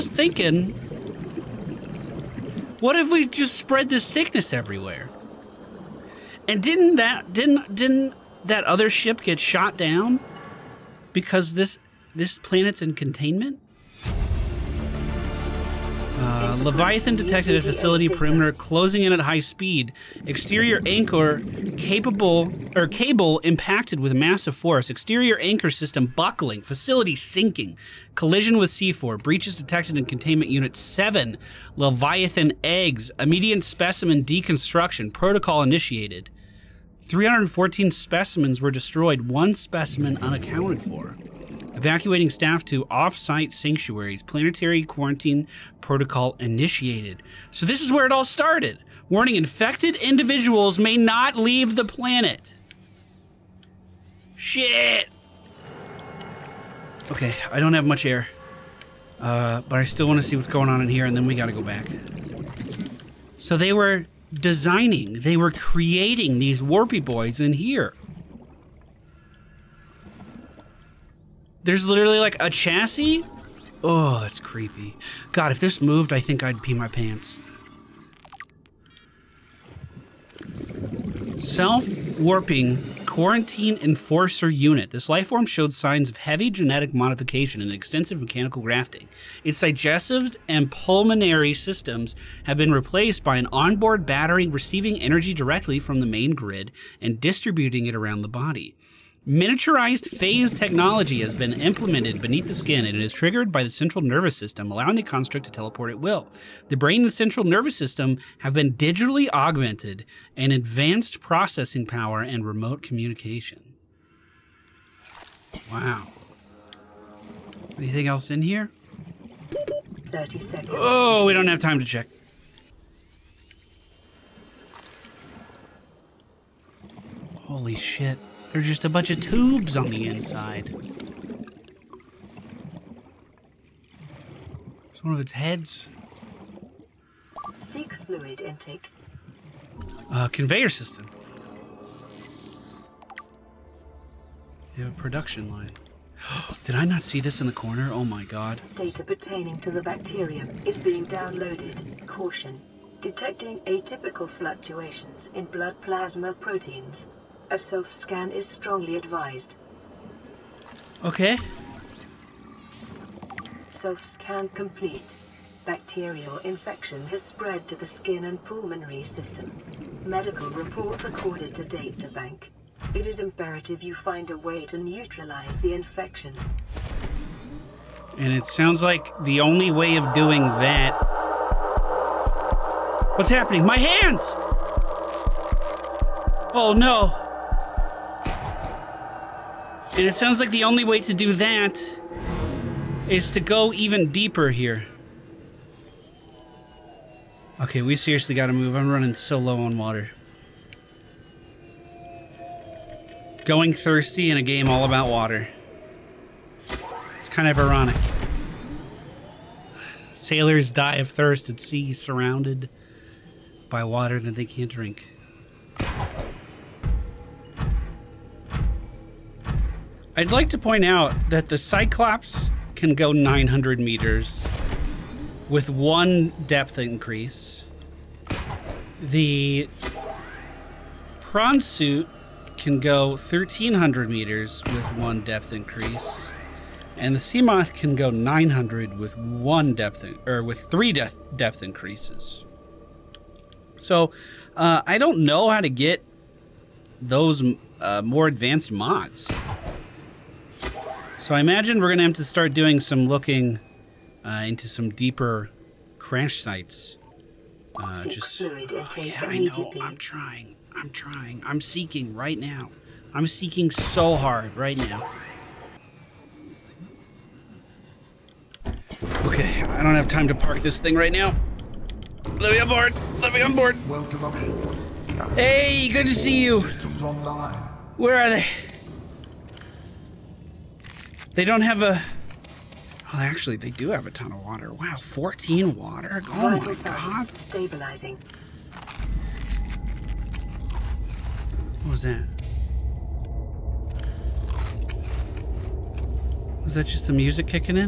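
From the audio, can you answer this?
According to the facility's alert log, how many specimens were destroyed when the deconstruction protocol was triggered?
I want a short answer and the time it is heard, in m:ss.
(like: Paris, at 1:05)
314, at 0:37.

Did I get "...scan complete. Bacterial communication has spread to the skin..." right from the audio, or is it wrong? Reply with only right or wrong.
wrong.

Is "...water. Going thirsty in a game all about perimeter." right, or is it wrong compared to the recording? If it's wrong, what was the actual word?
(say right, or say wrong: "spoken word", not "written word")
wrong: "water", not "perimeter".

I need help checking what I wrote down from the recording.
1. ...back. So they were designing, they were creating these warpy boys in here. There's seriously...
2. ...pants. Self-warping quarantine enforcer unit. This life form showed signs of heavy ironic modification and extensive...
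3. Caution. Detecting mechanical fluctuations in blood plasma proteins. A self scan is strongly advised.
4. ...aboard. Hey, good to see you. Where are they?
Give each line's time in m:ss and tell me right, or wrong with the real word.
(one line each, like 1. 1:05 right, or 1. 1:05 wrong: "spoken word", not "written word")
1. 1:01 wrong: "literally", not "seriously"
2. 1:16 wrong: "genetic", not "ironic"
3. 2:32 wrong: "atypical", not "mechanical"
4. 4:34 right.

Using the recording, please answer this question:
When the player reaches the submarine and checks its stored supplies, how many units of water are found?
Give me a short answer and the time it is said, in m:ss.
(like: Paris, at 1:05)
14, at 4:45.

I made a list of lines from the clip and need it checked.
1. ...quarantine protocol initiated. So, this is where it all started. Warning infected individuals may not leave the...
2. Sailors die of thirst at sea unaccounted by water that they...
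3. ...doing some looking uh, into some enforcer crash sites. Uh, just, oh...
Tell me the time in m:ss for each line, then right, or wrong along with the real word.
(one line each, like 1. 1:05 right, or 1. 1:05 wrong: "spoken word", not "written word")
1. 0:44 right
2. 3:30 wrong: "surrounded", not "unaccounted"
3. 4:12 wrong: "deeper", not "enforcer".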